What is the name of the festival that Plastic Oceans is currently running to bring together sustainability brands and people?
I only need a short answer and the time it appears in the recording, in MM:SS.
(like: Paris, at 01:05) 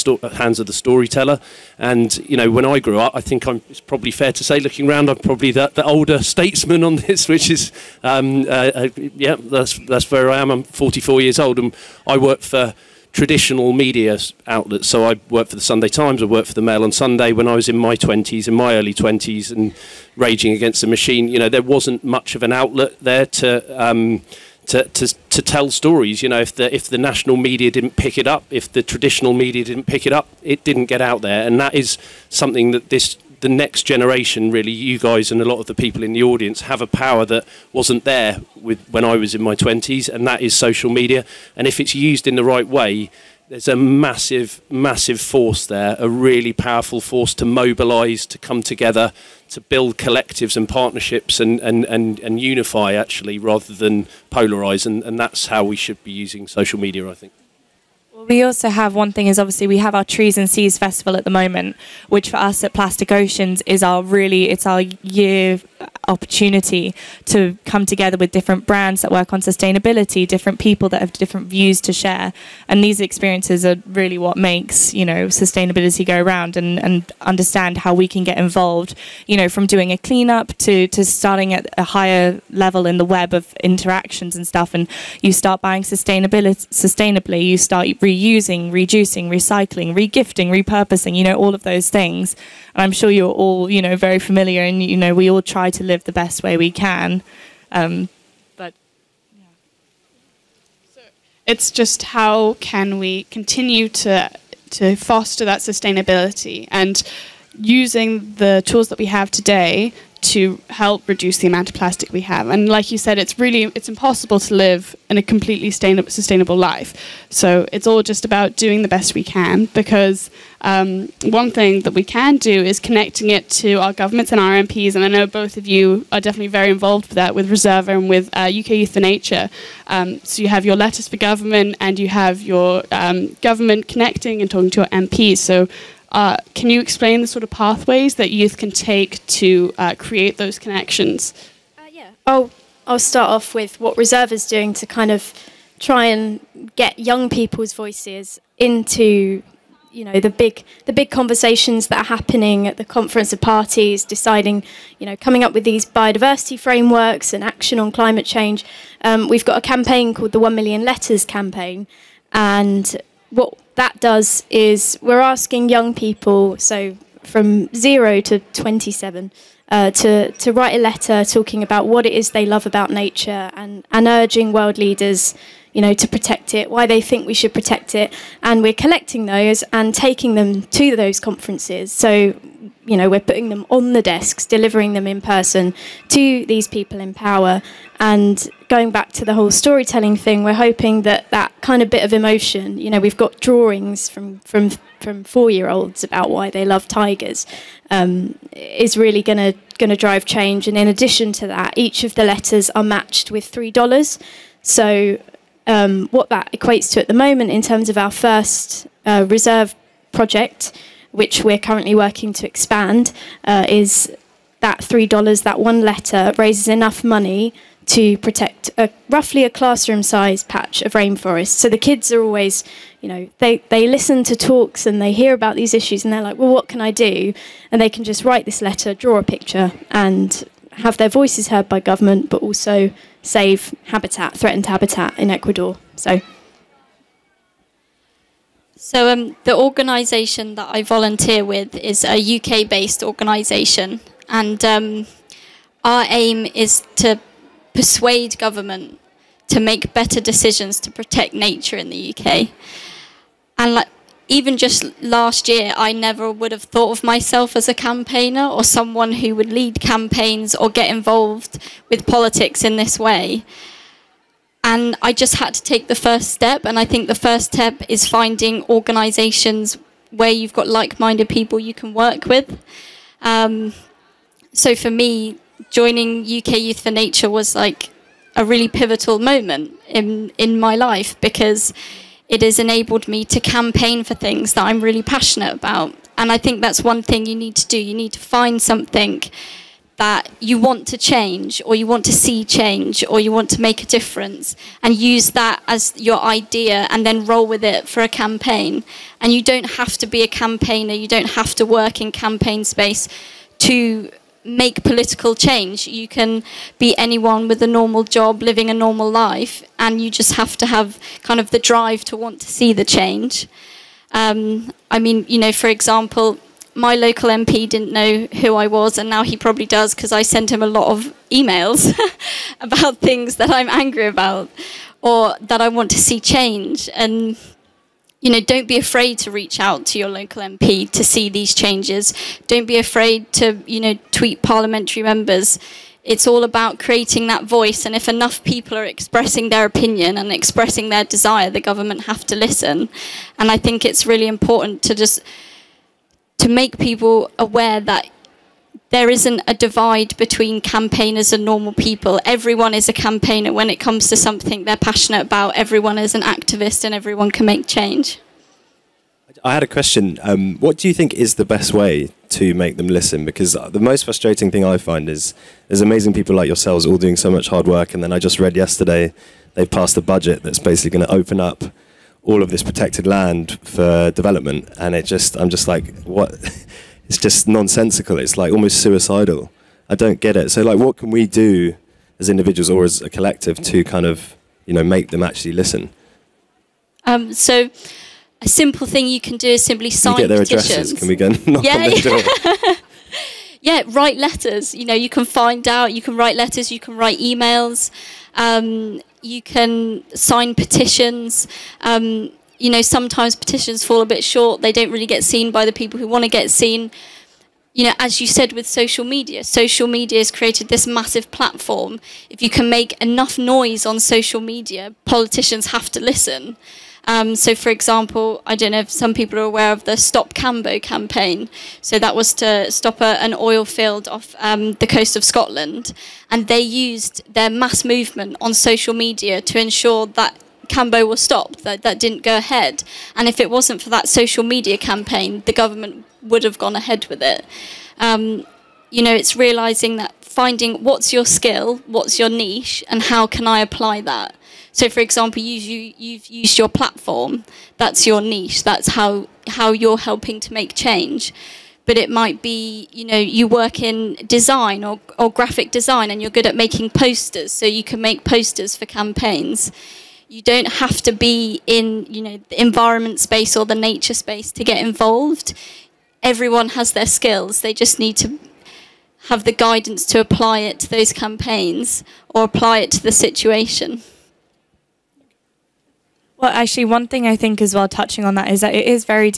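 Trees and Seas Festival, at 01:00.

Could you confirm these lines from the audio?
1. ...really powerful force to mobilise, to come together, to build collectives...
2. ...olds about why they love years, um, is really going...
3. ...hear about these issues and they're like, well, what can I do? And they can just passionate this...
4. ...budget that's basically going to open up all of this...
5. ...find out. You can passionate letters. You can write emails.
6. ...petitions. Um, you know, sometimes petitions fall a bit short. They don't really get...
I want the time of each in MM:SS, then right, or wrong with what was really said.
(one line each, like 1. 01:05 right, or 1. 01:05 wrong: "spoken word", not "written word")
1. 00:46 right
2. 03:15 wrong: "tigers", not "years"
3. 03:45 wrong: "write", not "passionate"
4. 06:10 right
5. 06:35 wrong: "write", not "passionate"
6. 06:40 right.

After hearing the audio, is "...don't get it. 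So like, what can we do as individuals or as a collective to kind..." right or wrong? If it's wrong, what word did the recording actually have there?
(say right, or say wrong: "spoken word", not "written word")
right.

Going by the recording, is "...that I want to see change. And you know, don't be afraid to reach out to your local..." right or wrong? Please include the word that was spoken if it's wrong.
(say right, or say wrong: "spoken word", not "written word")
right.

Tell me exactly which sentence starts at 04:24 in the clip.
And I just had to take the first step.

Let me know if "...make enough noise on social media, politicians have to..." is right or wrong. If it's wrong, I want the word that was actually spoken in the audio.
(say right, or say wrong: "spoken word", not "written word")
right.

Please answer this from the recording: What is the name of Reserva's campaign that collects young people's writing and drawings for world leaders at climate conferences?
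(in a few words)
1 million letters campaign.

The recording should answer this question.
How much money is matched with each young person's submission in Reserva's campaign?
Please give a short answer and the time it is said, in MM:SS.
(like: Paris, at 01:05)
$3, at 03:23.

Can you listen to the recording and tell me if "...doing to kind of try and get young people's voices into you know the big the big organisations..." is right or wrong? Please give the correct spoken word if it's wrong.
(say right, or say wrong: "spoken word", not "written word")
wrong: "conversations", not "organisations".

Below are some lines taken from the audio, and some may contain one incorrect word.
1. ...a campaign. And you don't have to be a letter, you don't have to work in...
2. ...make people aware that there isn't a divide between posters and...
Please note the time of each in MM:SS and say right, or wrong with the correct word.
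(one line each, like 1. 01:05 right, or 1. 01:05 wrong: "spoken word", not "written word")
1. 04:58 wrong: "campaigner", not "letter"
2. 05:46 wrong: "campaigners", not "posters".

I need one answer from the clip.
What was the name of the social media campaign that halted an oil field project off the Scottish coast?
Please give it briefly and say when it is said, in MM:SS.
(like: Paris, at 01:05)
Stop Cambo, at 06:59.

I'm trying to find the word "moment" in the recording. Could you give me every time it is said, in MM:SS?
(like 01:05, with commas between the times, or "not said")
01:01, 03:27, 04:39.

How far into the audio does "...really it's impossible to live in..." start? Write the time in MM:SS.
01:53.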